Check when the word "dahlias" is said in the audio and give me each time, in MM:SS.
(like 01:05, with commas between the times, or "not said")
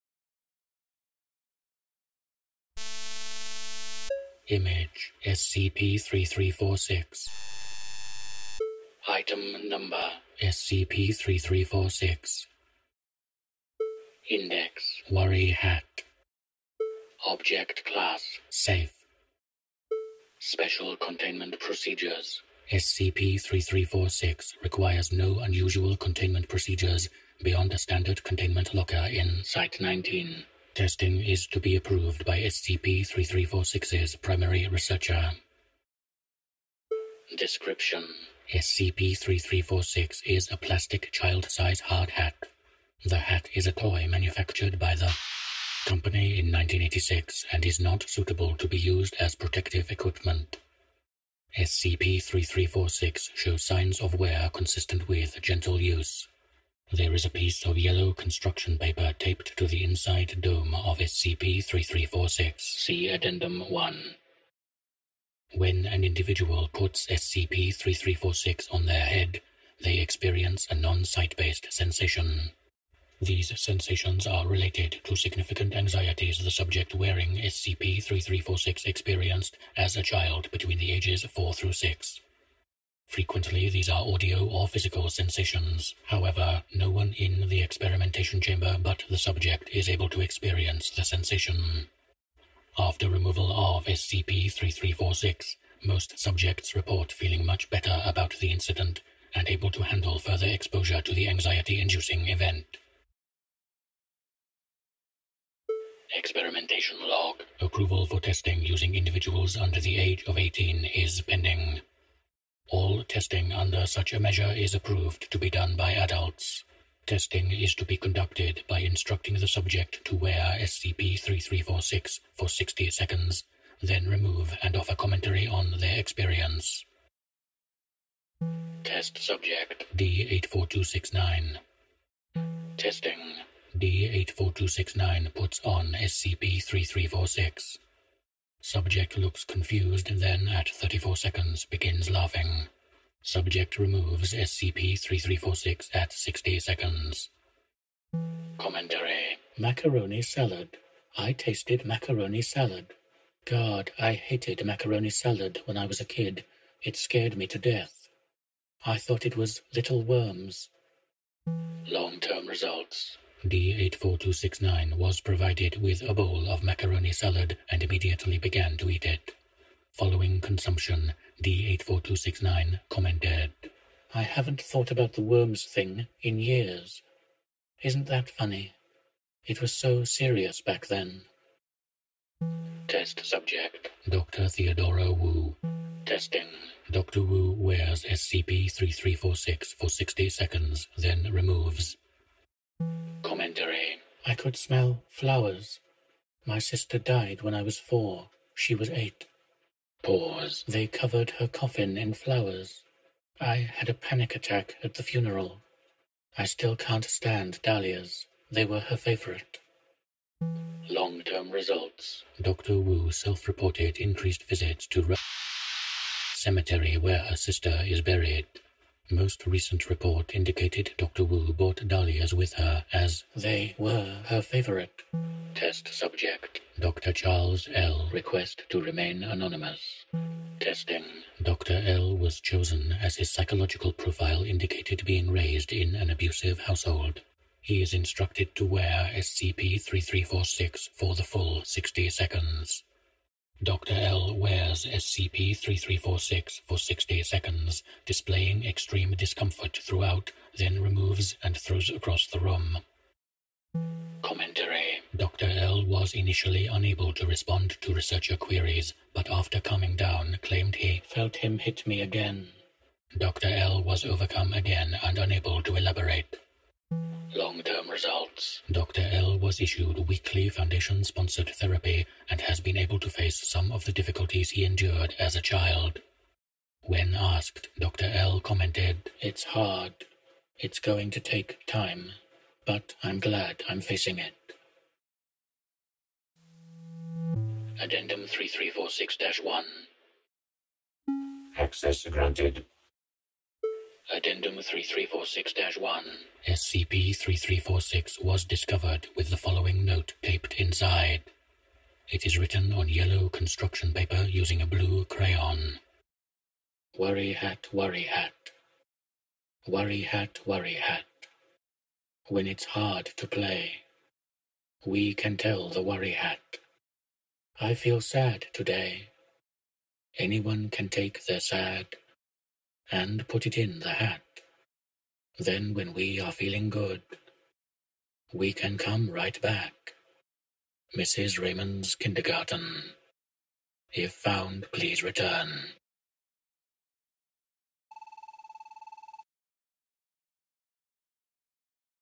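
03:27, 03:41.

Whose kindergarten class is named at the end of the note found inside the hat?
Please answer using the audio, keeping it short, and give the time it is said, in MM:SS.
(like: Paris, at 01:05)
Mrs. Raymond, at 05:30.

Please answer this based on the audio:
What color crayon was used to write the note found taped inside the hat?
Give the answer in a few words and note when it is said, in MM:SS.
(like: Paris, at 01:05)
blue, at 05:04.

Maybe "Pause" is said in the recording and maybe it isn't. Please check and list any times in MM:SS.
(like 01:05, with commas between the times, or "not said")
03:20.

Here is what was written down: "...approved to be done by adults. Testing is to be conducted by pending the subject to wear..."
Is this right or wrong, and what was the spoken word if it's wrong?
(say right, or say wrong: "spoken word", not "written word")
wrong: "instructing", not "pending".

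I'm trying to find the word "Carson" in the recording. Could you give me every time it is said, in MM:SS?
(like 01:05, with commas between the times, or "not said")
not said.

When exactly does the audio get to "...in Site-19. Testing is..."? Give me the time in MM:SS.
00:29.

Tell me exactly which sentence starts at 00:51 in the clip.
SCP-3346 shows signs of wear consistent with gentle use.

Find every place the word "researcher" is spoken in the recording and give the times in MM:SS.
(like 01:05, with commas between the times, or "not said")
00:34, 04:17.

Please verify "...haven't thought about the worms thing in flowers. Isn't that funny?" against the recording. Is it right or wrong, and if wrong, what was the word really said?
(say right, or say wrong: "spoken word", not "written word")
wrong: "years", not "flowers".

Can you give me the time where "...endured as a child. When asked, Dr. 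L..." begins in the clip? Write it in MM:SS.
04:34.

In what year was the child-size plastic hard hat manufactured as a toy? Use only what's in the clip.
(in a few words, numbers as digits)
1986.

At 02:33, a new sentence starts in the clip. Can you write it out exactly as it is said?
God, I hated macaroni salad when I was a kid.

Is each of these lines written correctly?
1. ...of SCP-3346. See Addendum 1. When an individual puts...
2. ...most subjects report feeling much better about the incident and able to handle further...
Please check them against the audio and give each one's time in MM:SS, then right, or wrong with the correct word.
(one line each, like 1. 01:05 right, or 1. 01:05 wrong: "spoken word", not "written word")
1. 01:00 right
2. 01:35 right.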